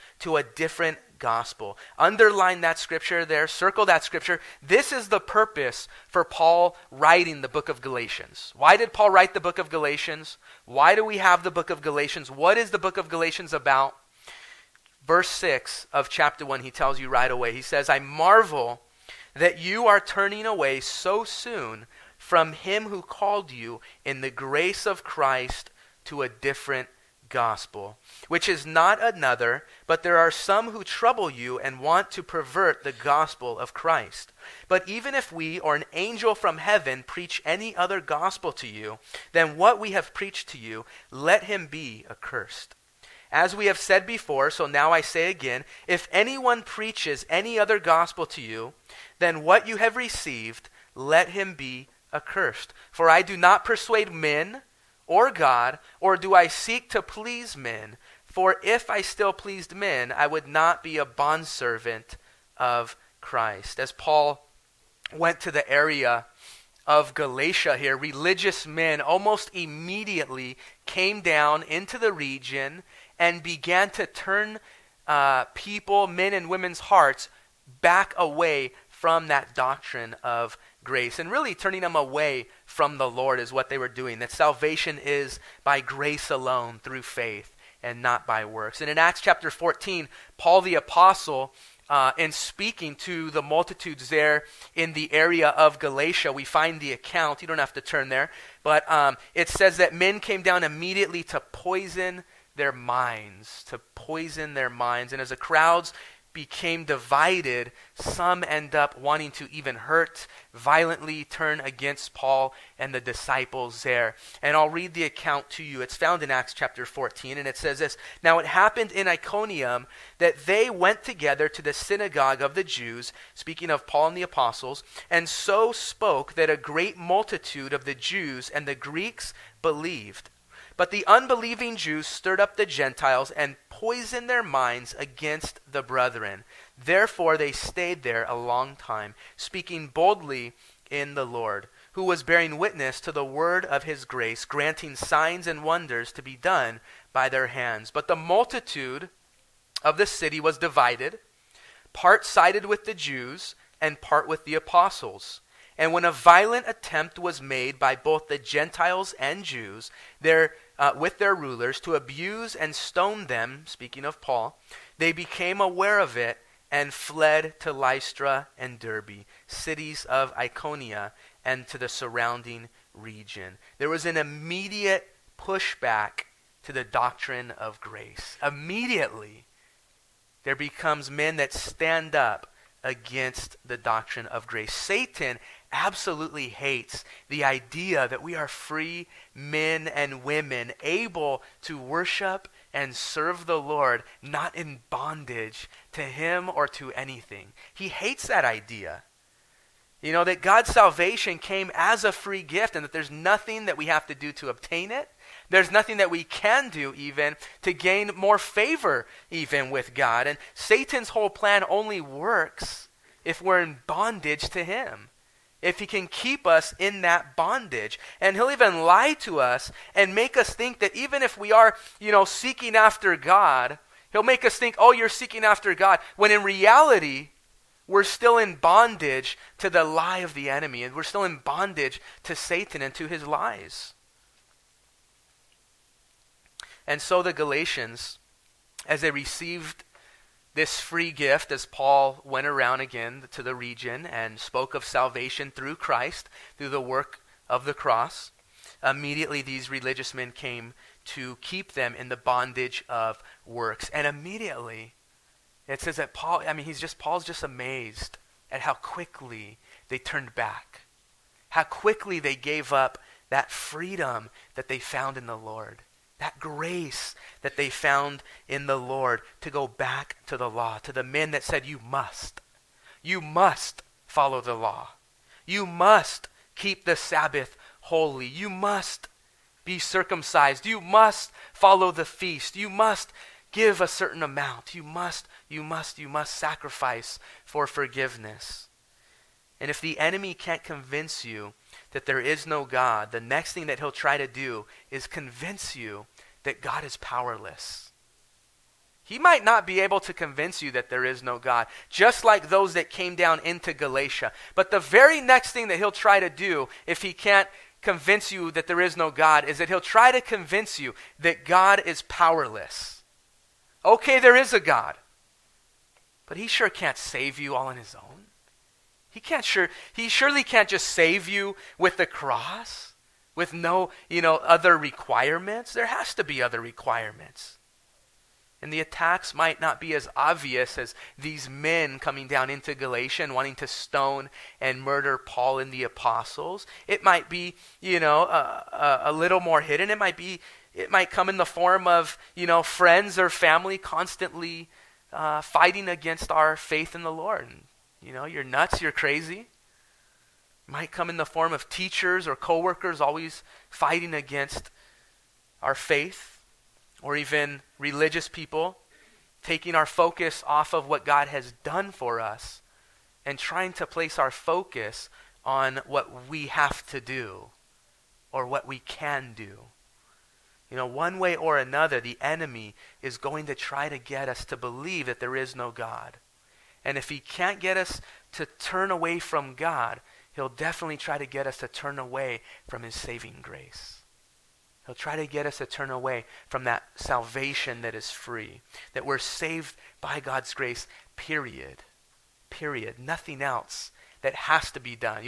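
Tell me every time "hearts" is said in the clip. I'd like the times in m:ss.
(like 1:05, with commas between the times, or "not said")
1:16.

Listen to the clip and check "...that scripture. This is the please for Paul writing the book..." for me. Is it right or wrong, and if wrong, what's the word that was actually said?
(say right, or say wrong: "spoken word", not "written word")
wrong: "purpose", not "please".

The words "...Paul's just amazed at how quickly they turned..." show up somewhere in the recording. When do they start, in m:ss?
4:16.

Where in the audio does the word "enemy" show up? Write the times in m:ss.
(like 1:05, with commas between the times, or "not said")
3:50, 4:49, 6:12.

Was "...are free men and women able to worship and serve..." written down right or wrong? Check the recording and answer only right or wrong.
right.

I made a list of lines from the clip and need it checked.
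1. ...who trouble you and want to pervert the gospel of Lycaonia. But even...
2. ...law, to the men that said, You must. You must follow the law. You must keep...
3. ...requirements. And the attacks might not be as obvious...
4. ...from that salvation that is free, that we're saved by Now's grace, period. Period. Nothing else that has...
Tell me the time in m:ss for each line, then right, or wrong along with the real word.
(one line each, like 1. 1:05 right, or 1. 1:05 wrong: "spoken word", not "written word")
1. 0:30 wrong: "Christ", not "Lycaonia"
2. 4:30 right
3. 5:26 right
4. 6:26 wrong: "God", not "Now".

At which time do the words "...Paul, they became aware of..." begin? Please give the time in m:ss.
2:44.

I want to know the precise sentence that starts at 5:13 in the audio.
Okay, there is a God, but he sure can't save you all on his own.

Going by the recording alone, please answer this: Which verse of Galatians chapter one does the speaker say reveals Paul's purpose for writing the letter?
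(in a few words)
Verse 6.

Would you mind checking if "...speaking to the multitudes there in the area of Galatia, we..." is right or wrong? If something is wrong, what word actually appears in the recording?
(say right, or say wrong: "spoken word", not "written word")
right.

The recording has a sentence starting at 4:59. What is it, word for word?
He might not be able to convince you that there is no God, just like those that came down into Galatia.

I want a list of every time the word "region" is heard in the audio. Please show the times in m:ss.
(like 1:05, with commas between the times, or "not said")
1:12, 2:52, 4:03.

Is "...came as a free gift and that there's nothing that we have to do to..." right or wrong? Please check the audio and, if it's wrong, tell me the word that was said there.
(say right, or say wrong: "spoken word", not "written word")
right.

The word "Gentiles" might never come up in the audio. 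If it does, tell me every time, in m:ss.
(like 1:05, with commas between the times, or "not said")
2:12, 2:38.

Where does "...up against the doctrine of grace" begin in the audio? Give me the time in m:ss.
3:02.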